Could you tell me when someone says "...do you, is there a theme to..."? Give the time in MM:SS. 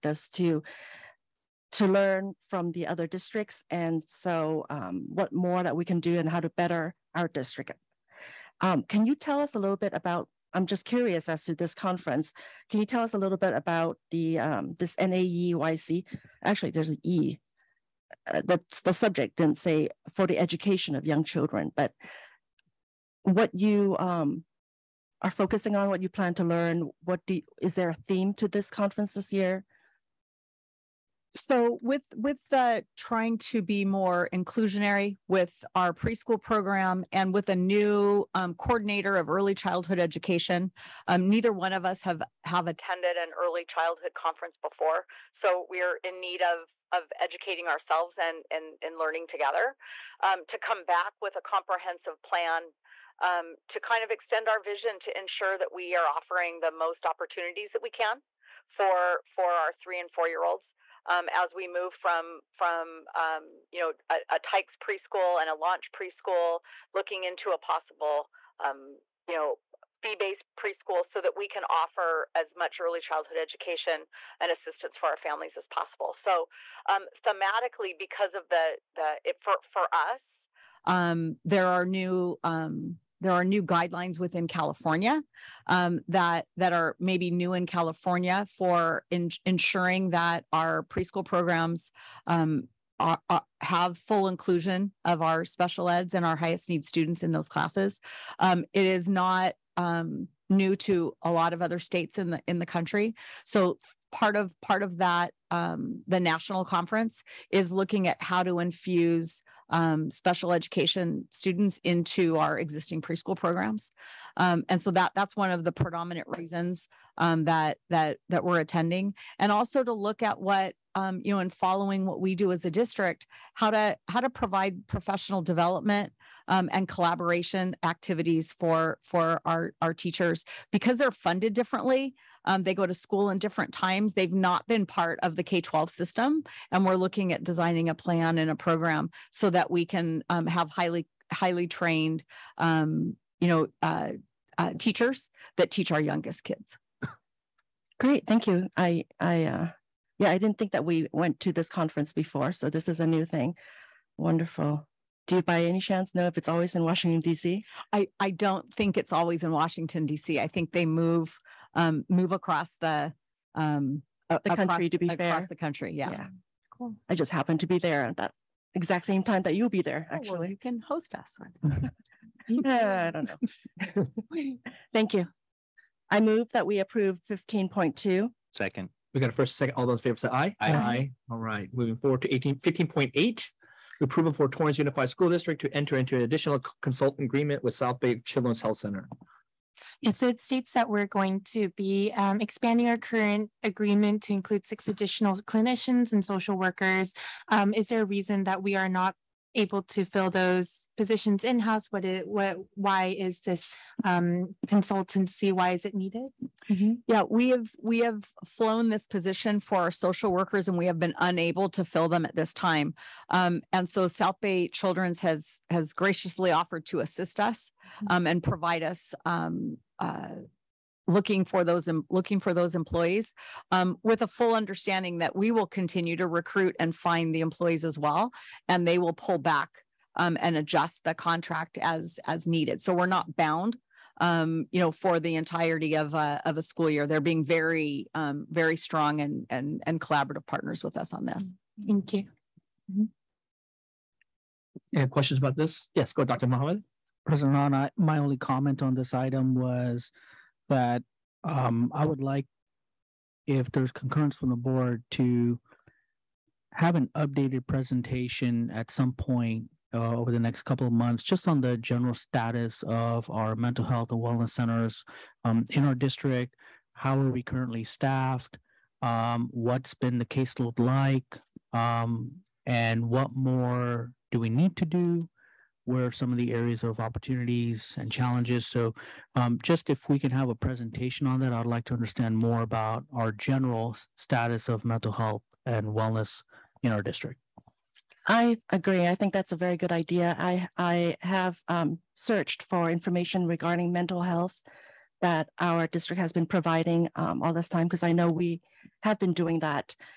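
00:27.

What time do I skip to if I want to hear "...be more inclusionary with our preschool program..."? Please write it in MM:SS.
00:33.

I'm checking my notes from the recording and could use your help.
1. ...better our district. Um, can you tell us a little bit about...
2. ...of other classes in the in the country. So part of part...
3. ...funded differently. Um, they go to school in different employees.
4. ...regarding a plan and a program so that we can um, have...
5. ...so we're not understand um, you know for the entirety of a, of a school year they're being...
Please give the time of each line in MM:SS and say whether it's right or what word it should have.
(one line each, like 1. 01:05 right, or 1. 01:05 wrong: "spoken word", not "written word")
1. 00:06 right
2. 01:41 wrong: "states", not "classes"
3. 02:11 wrong: "times", not "employees"
4. 02:17 wrong: "designing", not "regarding"
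5. 03:52 wrong: "bound", not "understand".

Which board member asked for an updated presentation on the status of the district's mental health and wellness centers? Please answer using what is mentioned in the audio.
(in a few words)
Dr. Mohammed.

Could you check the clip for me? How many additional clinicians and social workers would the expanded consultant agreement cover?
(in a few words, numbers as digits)
6.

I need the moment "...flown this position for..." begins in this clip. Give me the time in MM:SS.
03:28.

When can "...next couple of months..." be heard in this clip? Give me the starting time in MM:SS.
04:20.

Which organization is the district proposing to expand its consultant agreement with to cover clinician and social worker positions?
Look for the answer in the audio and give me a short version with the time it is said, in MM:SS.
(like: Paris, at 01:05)
South Bay Children's Health Center, at 03:07.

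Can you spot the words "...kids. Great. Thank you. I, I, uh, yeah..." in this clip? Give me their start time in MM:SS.
02:26.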